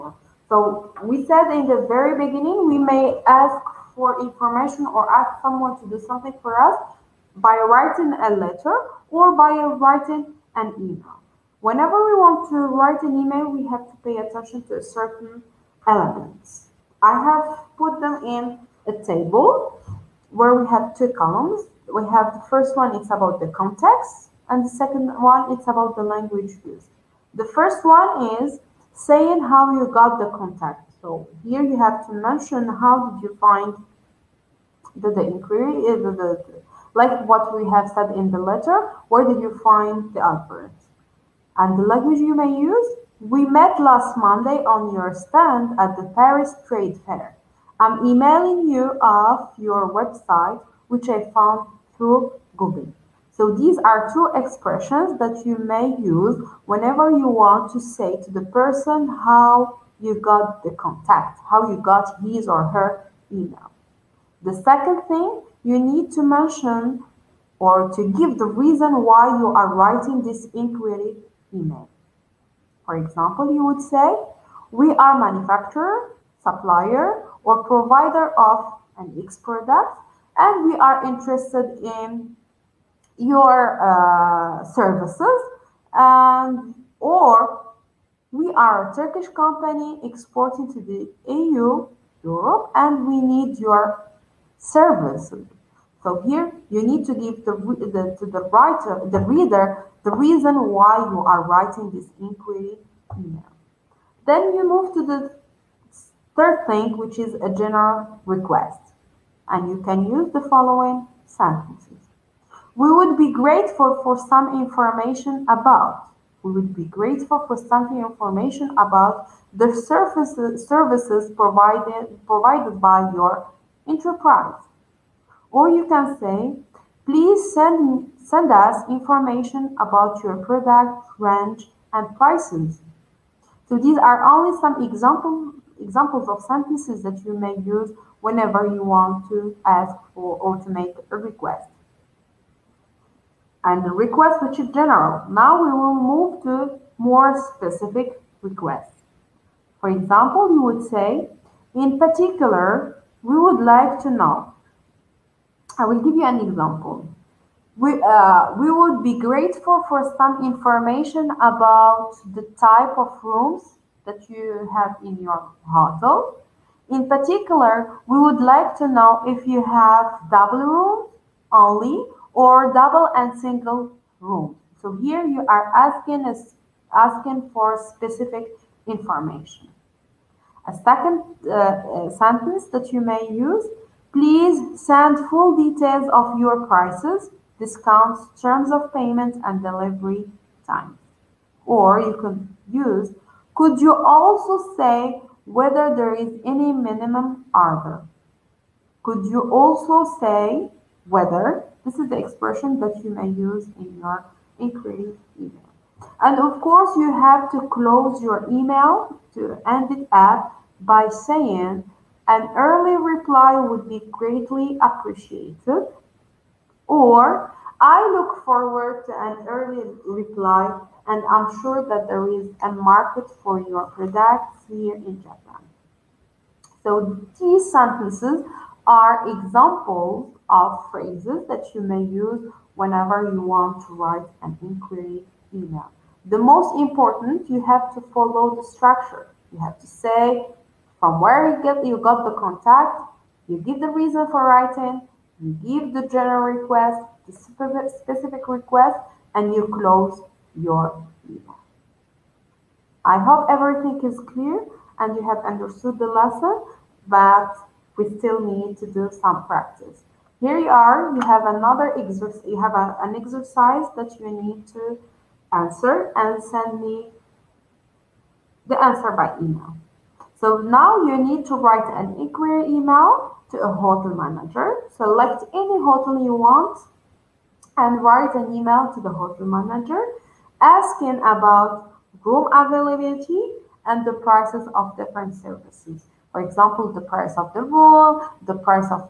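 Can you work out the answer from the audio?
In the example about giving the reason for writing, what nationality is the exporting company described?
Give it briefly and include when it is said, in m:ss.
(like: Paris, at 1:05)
Turkish, at 1:28.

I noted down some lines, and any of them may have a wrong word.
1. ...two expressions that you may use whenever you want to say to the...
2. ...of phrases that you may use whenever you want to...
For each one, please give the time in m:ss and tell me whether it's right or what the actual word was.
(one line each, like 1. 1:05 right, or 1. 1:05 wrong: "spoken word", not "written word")
1. 0:54 right
2. 3:50 right.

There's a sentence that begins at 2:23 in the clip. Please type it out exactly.
And the request which is general.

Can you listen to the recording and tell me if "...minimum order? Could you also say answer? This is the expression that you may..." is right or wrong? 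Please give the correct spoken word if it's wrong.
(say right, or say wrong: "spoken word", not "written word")
wrong: "whether", not "answer".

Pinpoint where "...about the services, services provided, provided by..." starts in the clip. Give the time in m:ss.
1:58.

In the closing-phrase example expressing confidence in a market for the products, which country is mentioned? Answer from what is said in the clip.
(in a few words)
Japan.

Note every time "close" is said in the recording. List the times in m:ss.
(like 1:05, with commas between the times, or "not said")
3:27, 4:09.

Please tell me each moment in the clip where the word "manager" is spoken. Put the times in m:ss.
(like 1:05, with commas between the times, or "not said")
4:34, 4:39.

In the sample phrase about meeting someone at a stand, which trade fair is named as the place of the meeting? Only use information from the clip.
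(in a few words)
Paris Trade Fair.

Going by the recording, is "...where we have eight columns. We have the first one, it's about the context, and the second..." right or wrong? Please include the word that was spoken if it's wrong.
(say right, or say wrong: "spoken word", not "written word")
wrong: "two", not "eight".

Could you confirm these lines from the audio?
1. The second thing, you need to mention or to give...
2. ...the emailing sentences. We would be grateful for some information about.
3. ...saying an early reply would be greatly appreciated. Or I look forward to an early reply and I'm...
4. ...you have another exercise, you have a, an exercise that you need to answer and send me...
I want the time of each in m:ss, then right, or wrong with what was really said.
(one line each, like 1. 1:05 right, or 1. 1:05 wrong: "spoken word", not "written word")
1. 1:04 right
2. 1:50 wrong: "following", not "emailing"
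3. 3:31 right
4. 4:21 right.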